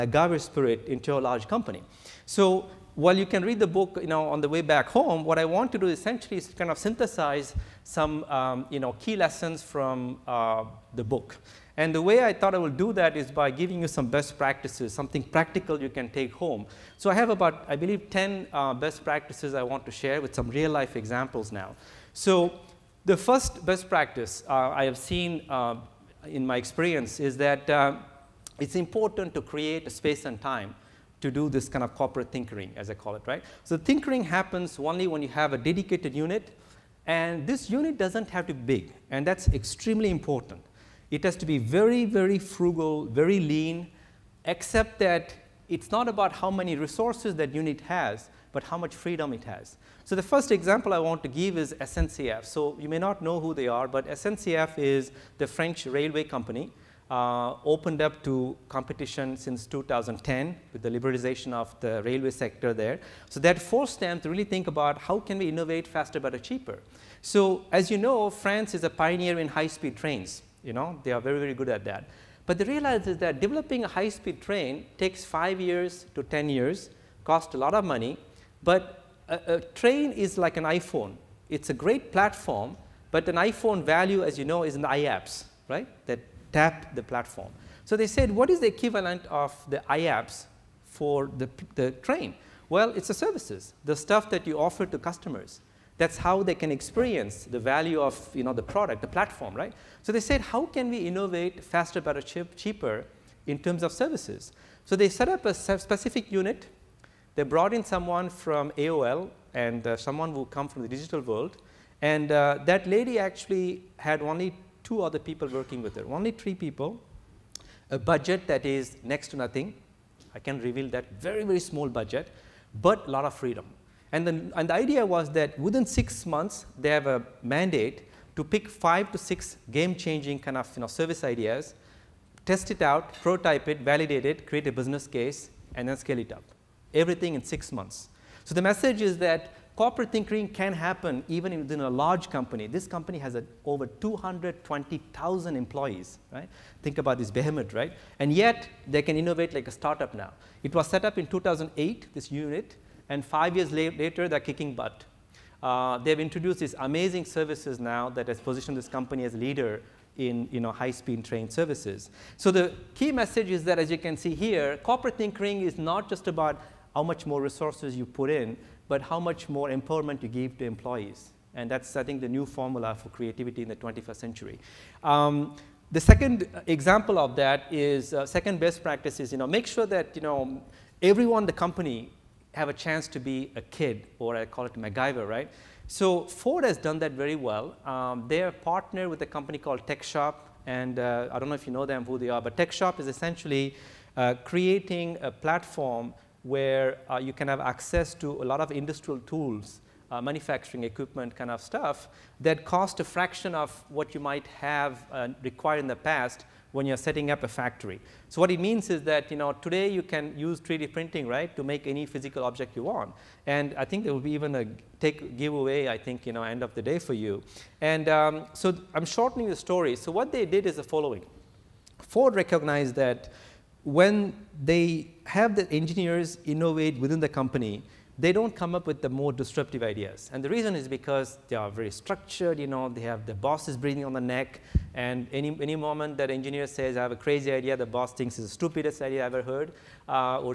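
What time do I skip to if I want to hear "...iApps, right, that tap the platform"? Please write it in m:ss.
1:24.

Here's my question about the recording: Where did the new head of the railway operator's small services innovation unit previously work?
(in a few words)
AOL.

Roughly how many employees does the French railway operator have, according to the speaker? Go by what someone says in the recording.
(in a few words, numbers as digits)
over 220,000.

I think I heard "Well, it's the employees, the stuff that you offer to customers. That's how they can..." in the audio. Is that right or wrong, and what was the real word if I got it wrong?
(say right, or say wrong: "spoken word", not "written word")
wrong: "services", not "employees".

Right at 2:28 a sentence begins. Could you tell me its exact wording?
And yet, they can innovate like a startup now.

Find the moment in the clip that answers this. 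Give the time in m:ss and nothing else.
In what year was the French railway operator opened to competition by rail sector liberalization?
0:59.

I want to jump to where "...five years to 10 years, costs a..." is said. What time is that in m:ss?
1:15.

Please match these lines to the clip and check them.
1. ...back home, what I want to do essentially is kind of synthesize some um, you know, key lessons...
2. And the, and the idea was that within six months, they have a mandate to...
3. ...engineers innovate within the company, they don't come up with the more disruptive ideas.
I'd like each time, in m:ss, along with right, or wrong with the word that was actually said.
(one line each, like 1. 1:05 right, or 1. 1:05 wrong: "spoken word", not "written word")
1. 0:04 right
2. 2:04 right
3. 3:45 right.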